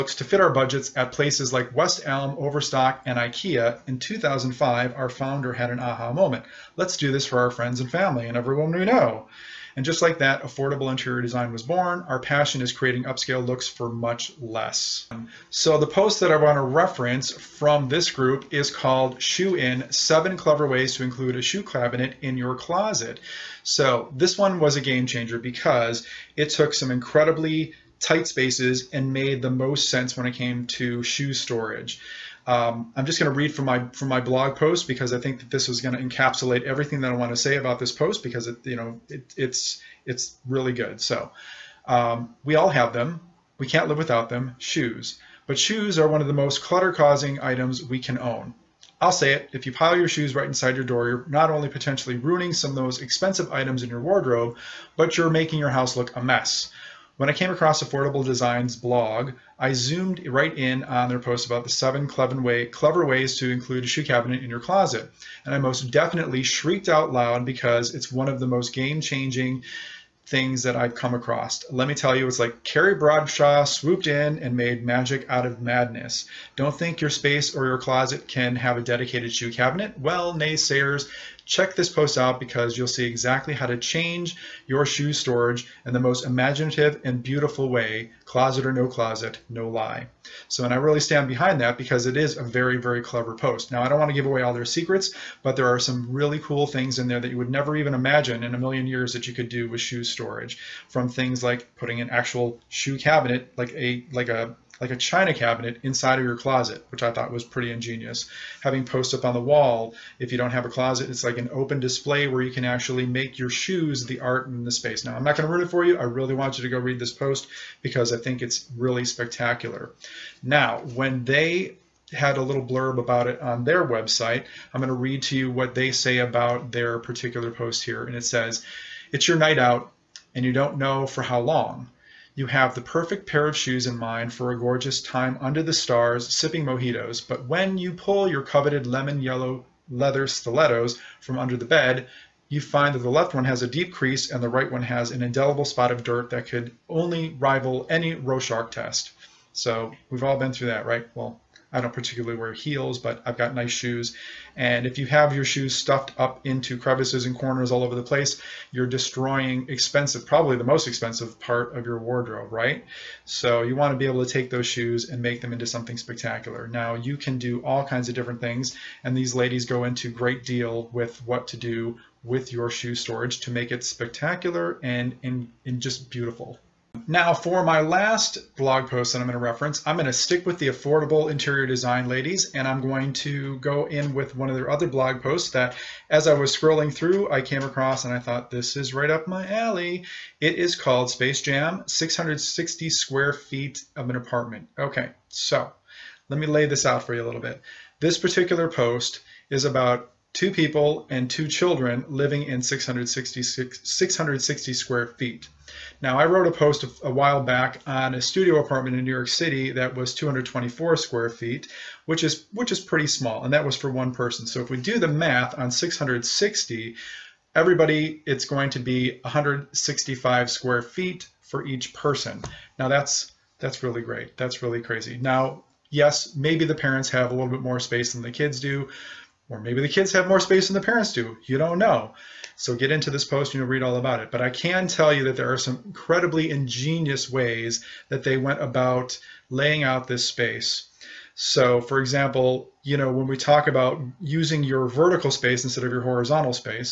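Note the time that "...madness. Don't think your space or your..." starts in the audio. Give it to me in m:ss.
1:15.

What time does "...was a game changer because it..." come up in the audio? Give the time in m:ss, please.
0:24.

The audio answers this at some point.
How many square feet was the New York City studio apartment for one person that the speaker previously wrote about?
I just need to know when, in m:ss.
3:30.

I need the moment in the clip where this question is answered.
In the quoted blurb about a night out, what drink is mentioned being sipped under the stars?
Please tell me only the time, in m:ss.
2:16.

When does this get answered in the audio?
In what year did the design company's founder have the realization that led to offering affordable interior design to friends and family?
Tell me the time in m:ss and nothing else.
0:03.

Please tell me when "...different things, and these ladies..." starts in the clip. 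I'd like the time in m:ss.
2:48.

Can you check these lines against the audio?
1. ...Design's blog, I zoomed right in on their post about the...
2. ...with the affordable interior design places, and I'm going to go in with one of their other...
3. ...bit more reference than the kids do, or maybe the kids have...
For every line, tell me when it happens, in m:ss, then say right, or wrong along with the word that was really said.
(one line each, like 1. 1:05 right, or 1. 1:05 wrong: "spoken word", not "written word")
1. 0:58 right
2. 3:00 wrong: "ladies", not "places"
3. 3:47 wrong: "space", not "reference".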